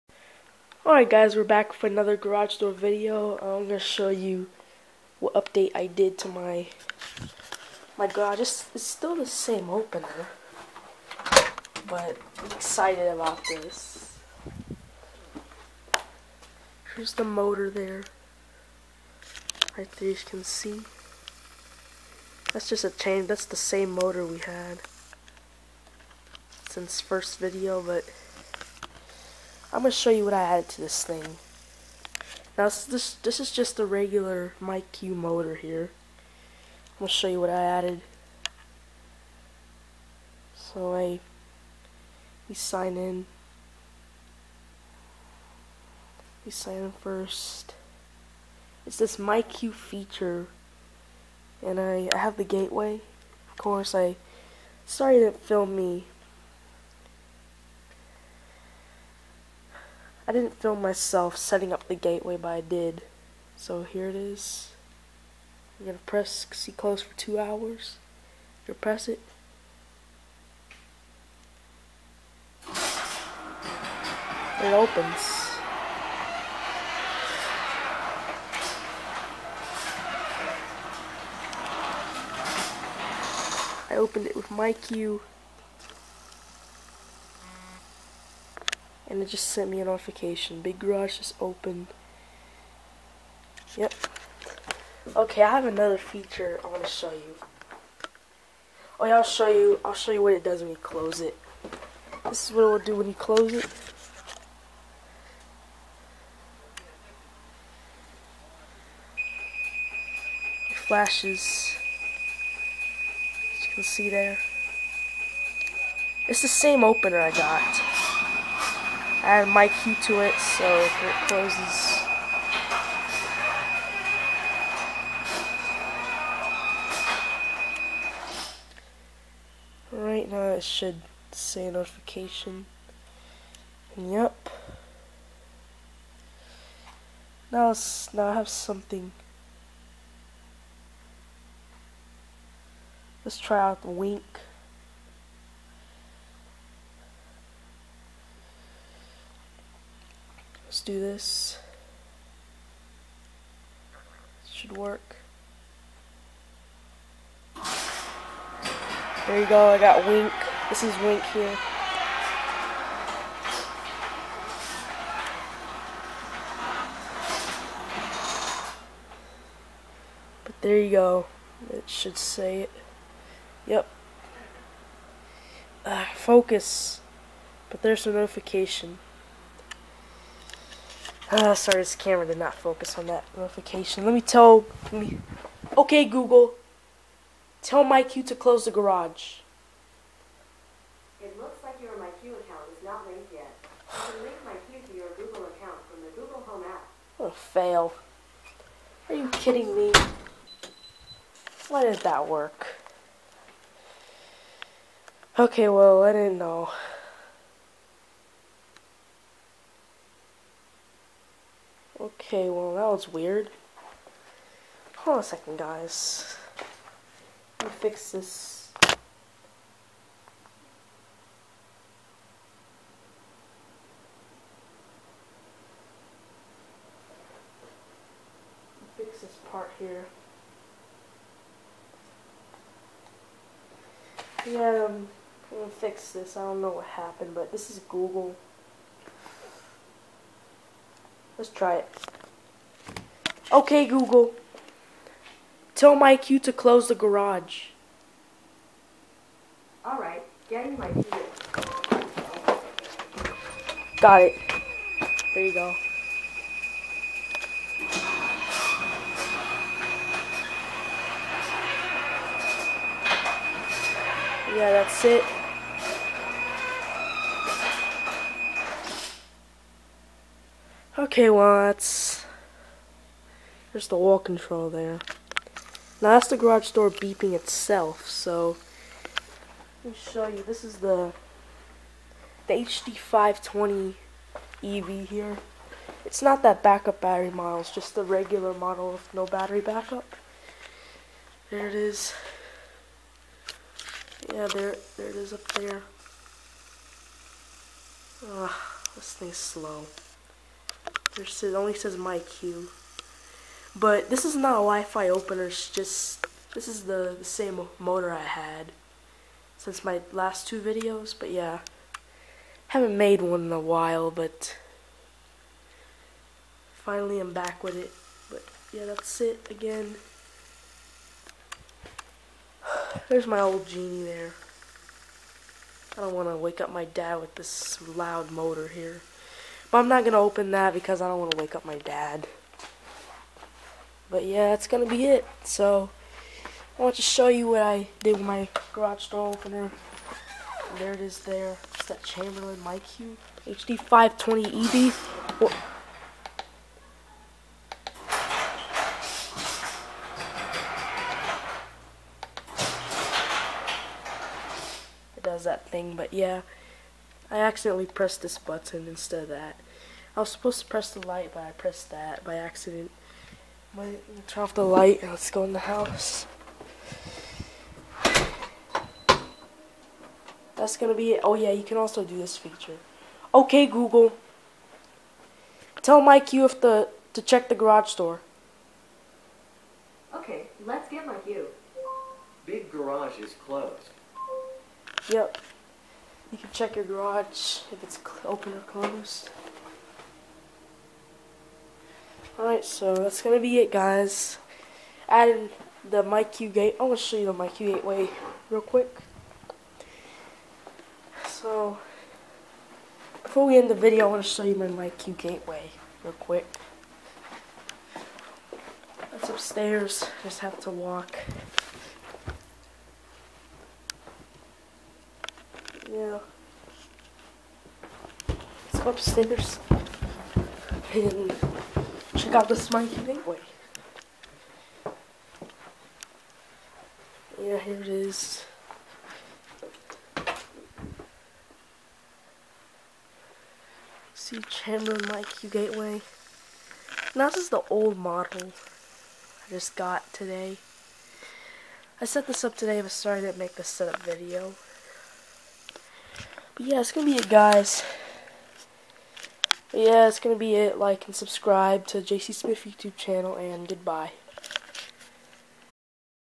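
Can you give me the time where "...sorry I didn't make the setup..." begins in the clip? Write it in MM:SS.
07:22.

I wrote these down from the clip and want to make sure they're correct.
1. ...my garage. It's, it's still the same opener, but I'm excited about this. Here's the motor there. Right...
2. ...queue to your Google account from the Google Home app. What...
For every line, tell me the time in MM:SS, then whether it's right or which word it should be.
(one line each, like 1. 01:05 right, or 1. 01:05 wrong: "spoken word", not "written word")
1. 00:07 right
2. 03:14 right.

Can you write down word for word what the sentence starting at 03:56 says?
I don't know what happened, but this is Google.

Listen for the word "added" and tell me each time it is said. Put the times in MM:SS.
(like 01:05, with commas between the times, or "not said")
00:30, 00:37, 06:35.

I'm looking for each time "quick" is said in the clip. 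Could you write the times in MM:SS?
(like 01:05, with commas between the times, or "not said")
06:38, 06:46.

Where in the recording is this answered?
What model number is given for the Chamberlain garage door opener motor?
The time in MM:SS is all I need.
04:42.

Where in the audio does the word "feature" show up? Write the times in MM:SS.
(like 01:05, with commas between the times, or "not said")
00:49, 01:35, 06:12.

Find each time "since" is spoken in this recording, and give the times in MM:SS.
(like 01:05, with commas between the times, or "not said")
00:26, 05:09.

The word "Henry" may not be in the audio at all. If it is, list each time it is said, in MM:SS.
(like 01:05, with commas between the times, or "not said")
not said.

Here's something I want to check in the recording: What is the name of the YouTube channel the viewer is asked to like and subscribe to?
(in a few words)
JC Smith.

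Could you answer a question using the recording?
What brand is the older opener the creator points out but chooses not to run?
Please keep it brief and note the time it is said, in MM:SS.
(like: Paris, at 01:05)
Genie, at 05:23.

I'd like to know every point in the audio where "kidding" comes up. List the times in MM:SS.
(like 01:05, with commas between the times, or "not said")
03:19.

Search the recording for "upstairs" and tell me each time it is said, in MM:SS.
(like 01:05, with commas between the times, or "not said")
06:49, 06:58.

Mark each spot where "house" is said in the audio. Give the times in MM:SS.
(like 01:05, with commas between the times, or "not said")
06:05.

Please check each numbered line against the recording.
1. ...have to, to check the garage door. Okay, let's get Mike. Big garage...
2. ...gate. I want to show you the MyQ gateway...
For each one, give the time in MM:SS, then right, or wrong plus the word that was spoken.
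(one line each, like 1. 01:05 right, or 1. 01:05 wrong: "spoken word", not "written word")
1. 06:16 wrong: "MyQ", not "Mike"
2. 06:36 right.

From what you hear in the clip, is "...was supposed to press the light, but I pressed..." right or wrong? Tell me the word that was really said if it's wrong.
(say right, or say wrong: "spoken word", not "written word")
right.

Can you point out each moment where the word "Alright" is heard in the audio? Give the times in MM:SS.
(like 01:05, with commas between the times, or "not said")
00:00, 04:09, 06:32.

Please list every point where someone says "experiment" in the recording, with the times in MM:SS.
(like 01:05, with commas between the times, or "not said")
not said.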